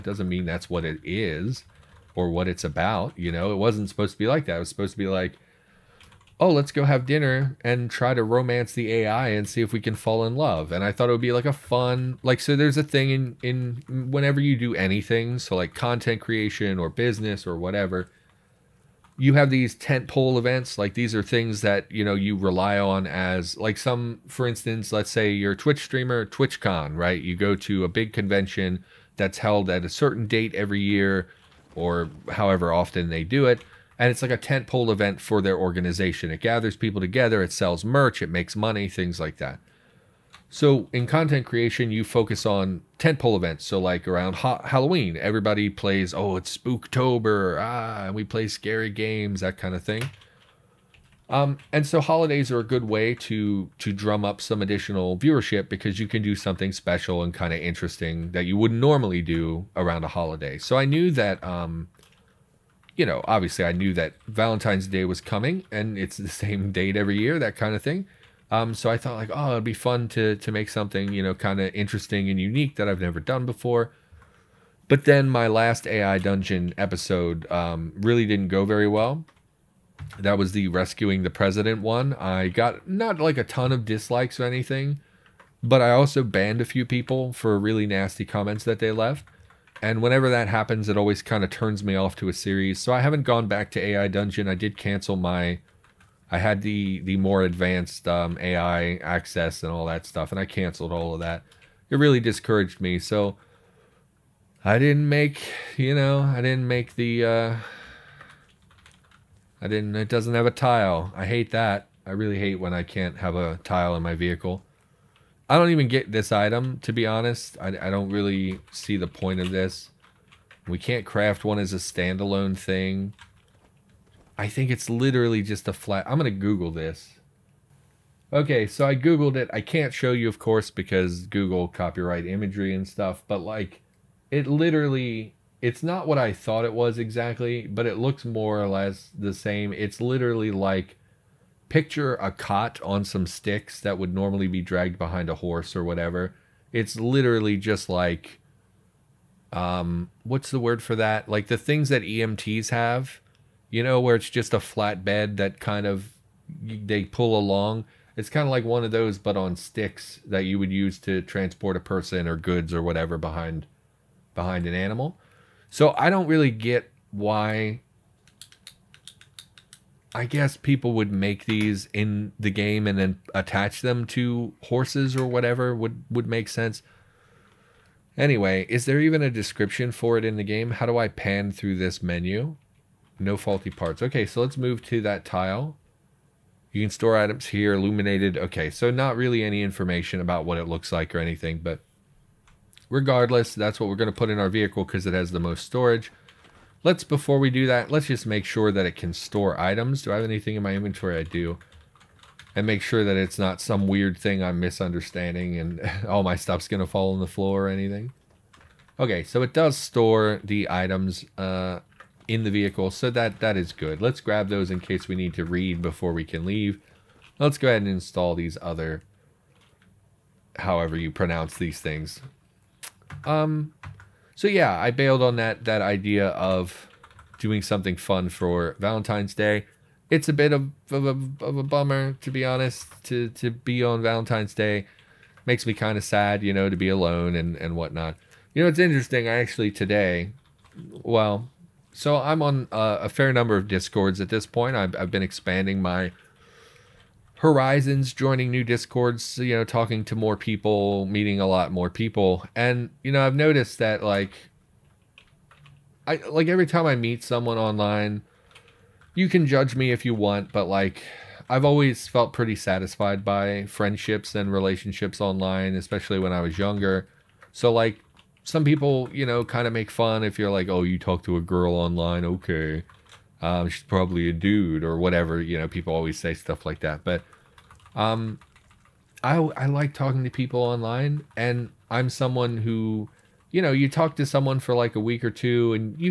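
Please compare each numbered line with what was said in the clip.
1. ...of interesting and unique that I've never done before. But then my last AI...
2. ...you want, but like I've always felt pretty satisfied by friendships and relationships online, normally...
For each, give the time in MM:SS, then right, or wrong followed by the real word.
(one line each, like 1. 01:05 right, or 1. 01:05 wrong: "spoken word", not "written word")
1. 01:11 right
2. 04:20 wrong: "especially", not "normally".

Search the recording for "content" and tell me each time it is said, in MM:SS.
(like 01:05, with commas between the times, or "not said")
00:15, 00:41.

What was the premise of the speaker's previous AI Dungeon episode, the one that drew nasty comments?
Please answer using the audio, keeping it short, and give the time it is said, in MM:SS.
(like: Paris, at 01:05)
Rescuing the president, at 01:20.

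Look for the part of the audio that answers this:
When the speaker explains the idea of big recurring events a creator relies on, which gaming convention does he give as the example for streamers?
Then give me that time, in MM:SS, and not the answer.
00:26.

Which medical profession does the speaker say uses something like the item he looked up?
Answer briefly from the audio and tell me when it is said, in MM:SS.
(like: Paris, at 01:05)
EMTs, at 02:32.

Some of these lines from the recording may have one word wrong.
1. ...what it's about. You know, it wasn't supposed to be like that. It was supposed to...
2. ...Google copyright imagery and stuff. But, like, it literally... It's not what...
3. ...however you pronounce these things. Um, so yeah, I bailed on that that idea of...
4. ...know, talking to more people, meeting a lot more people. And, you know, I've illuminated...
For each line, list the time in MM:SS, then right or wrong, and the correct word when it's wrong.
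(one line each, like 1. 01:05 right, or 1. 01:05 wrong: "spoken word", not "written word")
1. 00:02 right
2. 02:11 right
3. 03:40 right
4. 04:09 wrong: "noticed", not "illuminated".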